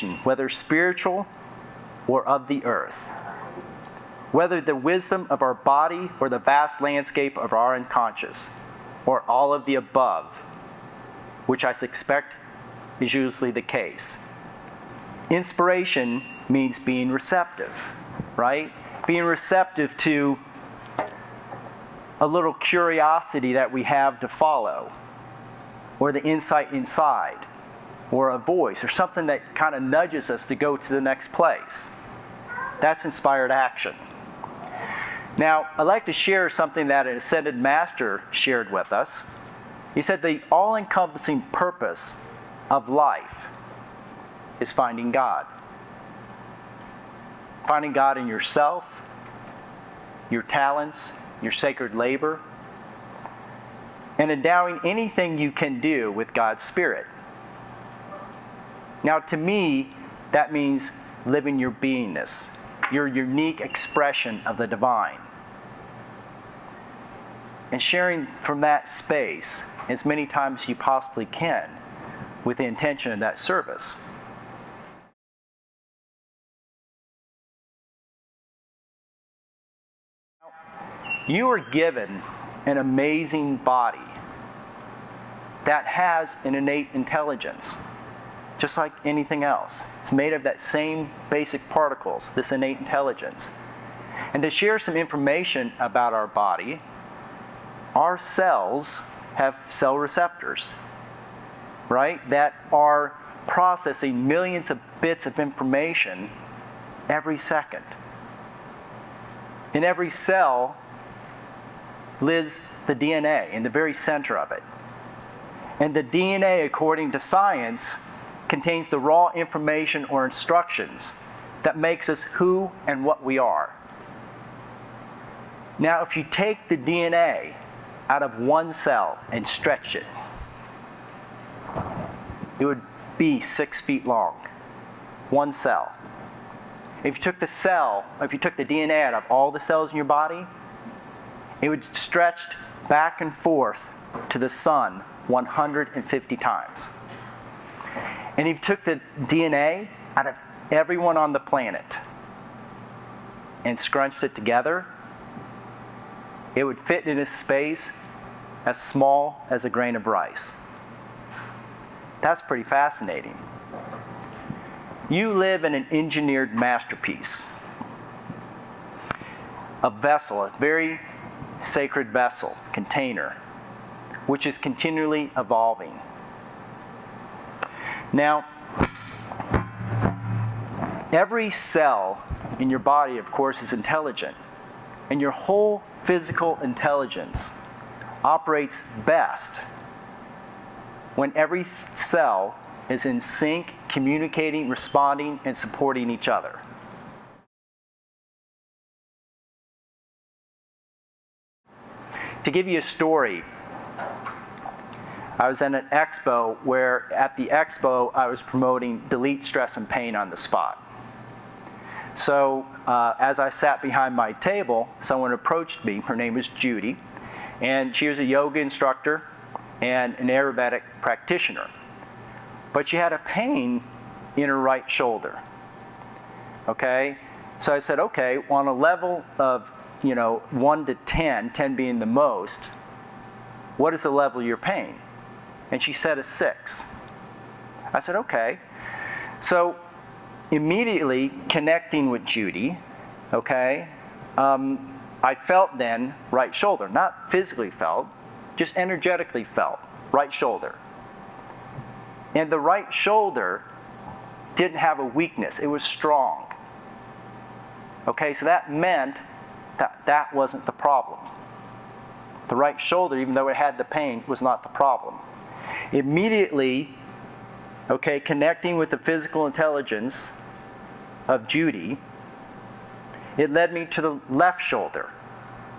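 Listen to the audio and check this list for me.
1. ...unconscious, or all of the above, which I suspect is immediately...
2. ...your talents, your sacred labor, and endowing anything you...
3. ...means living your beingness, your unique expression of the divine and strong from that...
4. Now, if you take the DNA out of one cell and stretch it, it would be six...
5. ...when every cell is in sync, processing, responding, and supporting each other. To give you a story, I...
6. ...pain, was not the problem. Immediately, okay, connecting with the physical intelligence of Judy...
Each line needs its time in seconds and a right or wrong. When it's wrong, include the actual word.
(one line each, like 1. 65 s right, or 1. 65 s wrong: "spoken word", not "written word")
1. 7 s wrong: "usually", not "immediately"
2. 50 s right
3. 60 s wrong: "sharing", not "strong"
4. 125 s right
5. 191 s wrong: "communicating", not "processing"
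6. 263 s right.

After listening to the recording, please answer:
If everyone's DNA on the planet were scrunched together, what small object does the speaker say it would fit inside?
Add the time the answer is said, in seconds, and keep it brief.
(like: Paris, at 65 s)
a grain of rice, at 159 s.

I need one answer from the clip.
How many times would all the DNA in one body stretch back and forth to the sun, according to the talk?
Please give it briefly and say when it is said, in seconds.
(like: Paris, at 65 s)
150, at 145 s.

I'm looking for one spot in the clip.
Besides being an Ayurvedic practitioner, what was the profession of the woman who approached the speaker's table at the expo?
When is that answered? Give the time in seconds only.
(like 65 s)
218 s.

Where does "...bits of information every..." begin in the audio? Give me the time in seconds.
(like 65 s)
105 s.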